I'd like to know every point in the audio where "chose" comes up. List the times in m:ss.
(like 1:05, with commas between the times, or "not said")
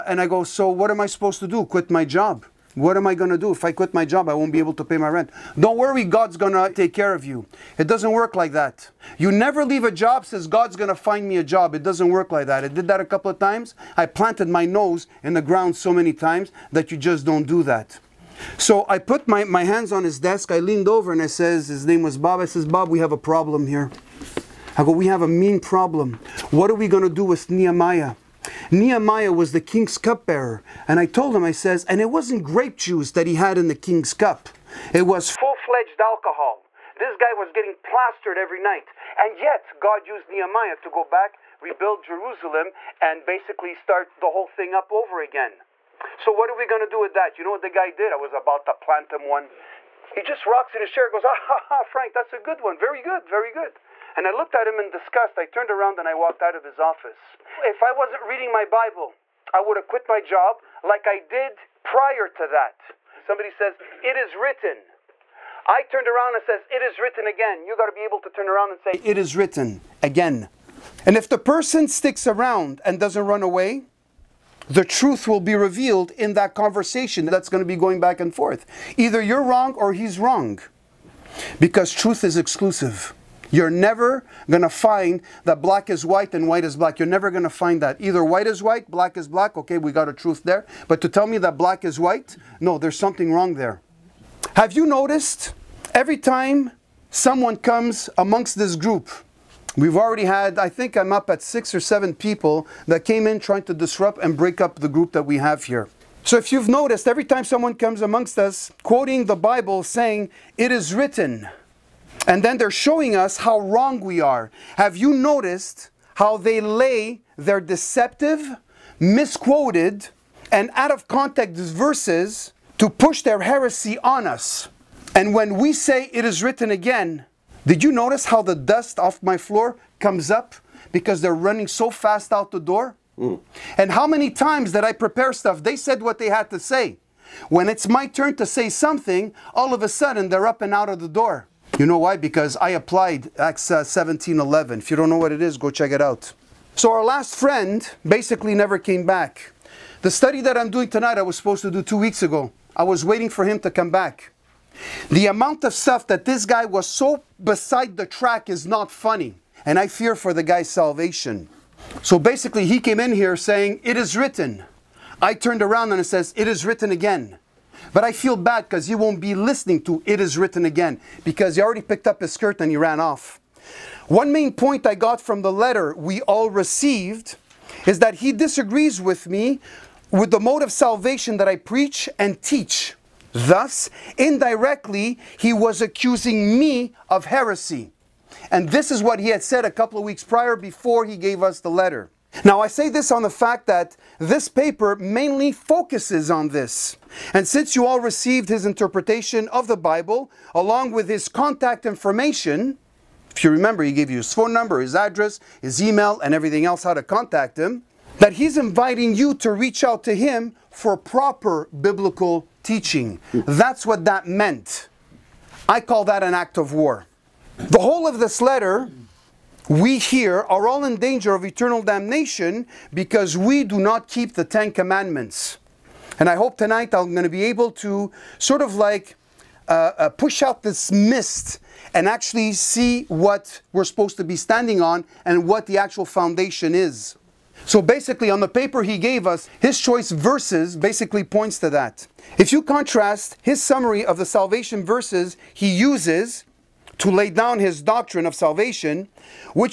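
not said.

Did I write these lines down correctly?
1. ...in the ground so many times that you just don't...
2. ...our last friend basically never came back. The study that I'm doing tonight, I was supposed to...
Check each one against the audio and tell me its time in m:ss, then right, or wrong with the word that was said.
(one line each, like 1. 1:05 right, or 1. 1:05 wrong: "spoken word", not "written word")
1. 0:15 right
2. 2:26 right.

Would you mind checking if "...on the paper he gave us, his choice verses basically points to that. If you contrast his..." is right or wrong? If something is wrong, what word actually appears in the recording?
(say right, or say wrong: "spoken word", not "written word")
right.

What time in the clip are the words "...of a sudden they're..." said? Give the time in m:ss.
2:19.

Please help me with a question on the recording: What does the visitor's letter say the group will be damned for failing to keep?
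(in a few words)
the Ten Commandments.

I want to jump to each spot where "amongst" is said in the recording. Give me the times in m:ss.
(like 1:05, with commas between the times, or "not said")
1:38, 1:48.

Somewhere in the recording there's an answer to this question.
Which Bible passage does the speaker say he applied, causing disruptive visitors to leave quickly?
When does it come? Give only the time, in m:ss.
2:23.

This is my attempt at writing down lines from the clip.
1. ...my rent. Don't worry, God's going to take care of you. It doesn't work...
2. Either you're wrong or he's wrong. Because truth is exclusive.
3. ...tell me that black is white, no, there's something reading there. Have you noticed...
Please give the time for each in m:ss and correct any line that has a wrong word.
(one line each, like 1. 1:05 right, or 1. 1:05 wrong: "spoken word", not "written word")
1. 0:04 right
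2. 1:18 right
3. 1:31 wrong: "wrong", not "reading".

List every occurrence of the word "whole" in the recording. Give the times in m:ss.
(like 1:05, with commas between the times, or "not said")
0:44, 3:37.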